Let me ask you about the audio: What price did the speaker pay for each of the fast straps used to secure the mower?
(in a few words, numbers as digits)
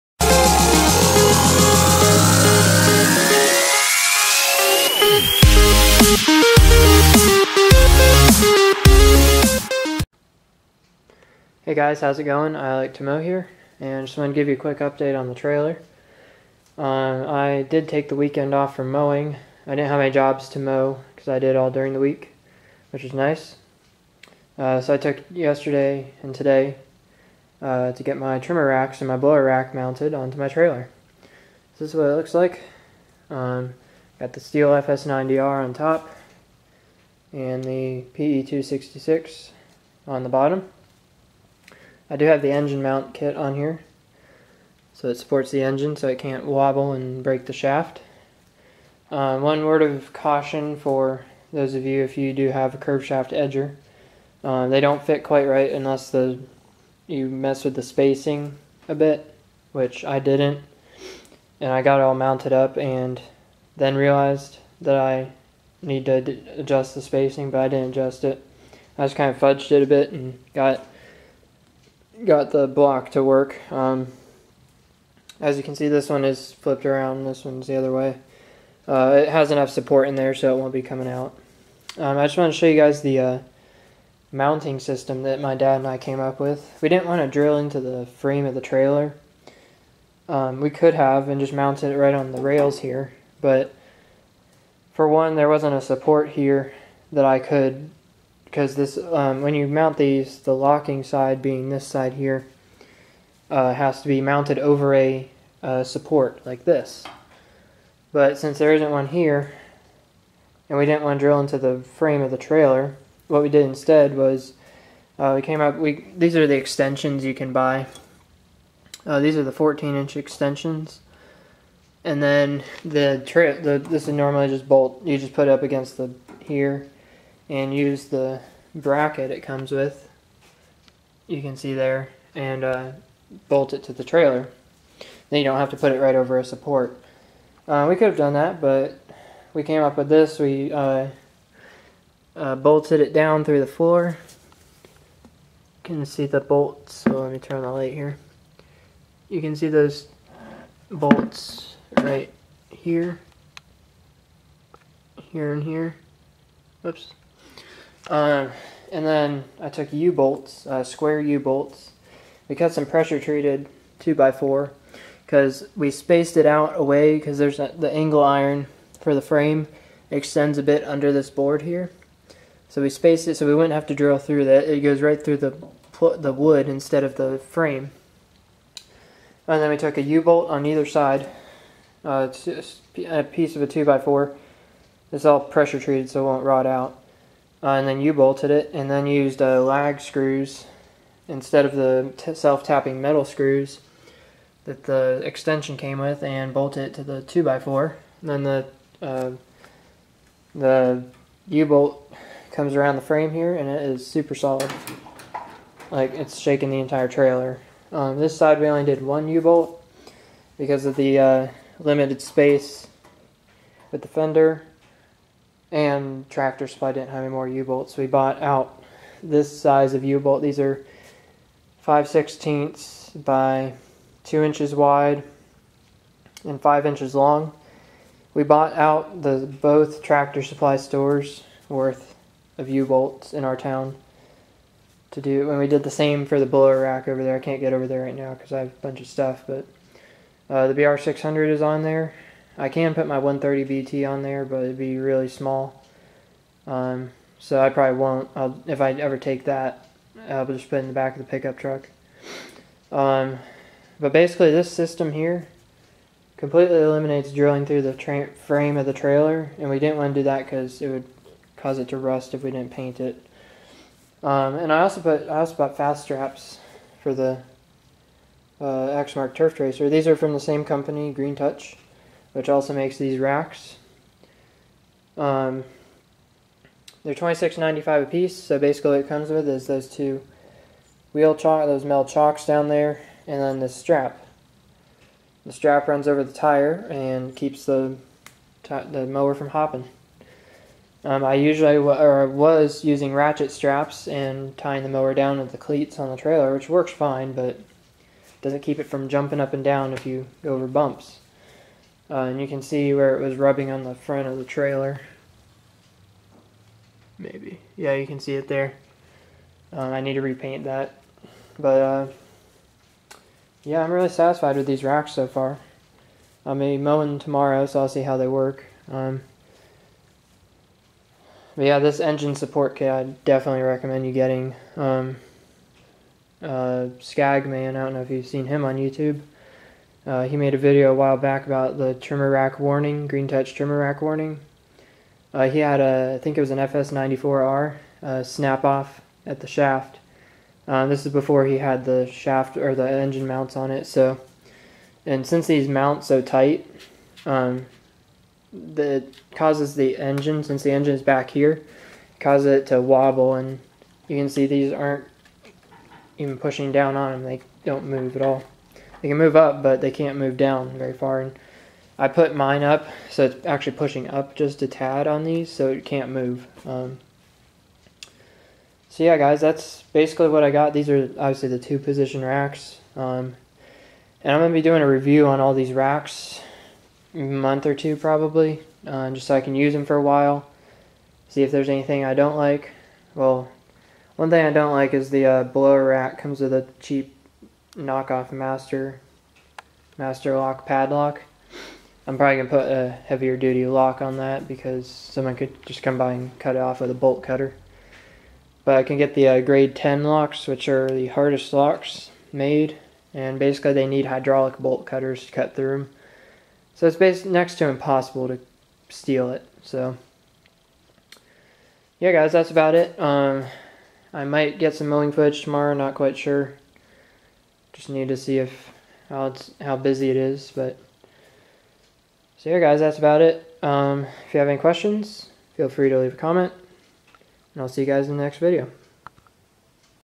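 $26.95.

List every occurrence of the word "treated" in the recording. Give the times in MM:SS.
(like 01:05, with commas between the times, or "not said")
02:43, 03:05.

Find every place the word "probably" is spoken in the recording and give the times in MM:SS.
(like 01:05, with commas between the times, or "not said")
04:07, 06:17, 06:32.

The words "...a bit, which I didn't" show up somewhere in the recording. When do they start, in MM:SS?
00:58.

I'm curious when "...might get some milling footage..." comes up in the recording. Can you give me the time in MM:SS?
06:54.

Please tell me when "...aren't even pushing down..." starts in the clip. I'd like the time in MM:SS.
05:54.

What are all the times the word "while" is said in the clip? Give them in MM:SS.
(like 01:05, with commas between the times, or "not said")
05:30, 06:20.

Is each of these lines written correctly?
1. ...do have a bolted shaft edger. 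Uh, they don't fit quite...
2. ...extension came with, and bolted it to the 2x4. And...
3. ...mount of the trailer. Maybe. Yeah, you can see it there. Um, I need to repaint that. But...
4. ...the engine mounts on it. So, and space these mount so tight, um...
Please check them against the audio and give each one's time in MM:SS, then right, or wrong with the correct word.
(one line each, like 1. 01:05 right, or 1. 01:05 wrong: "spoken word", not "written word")
1. 00:52 wrong: "curved", not "bolted"
2. 03:15 right
3. 05:03 wrong: "front", not "mount"
4. 05:42 wrong: "since", not "space".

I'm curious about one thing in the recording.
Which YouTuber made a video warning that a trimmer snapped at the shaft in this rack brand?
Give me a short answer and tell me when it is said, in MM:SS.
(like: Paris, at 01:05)
Skagman, at 05:26.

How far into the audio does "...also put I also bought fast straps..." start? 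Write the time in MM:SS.
04:24.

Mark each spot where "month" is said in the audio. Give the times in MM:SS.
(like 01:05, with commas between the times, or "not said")
06:17.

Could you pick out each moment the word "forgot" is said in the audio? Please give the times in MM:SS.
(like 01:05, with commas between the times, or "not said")
not said.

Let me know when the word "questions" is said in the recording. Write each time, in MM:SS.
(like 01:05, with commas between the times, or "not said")
07:04.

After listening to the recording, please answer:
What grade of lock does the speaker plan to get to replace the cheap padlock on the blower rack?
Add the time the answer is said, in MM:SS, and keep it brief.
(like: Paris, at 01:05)
grade 10, at 06:39.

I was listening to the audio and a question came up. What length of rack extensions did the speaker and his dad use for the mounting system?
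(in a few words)
14 inch.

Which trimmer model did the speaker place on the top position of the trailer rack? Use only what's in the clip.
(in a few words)
Stihl FS90R.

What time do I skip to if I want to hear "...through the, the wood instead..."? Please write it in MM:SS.
02:55.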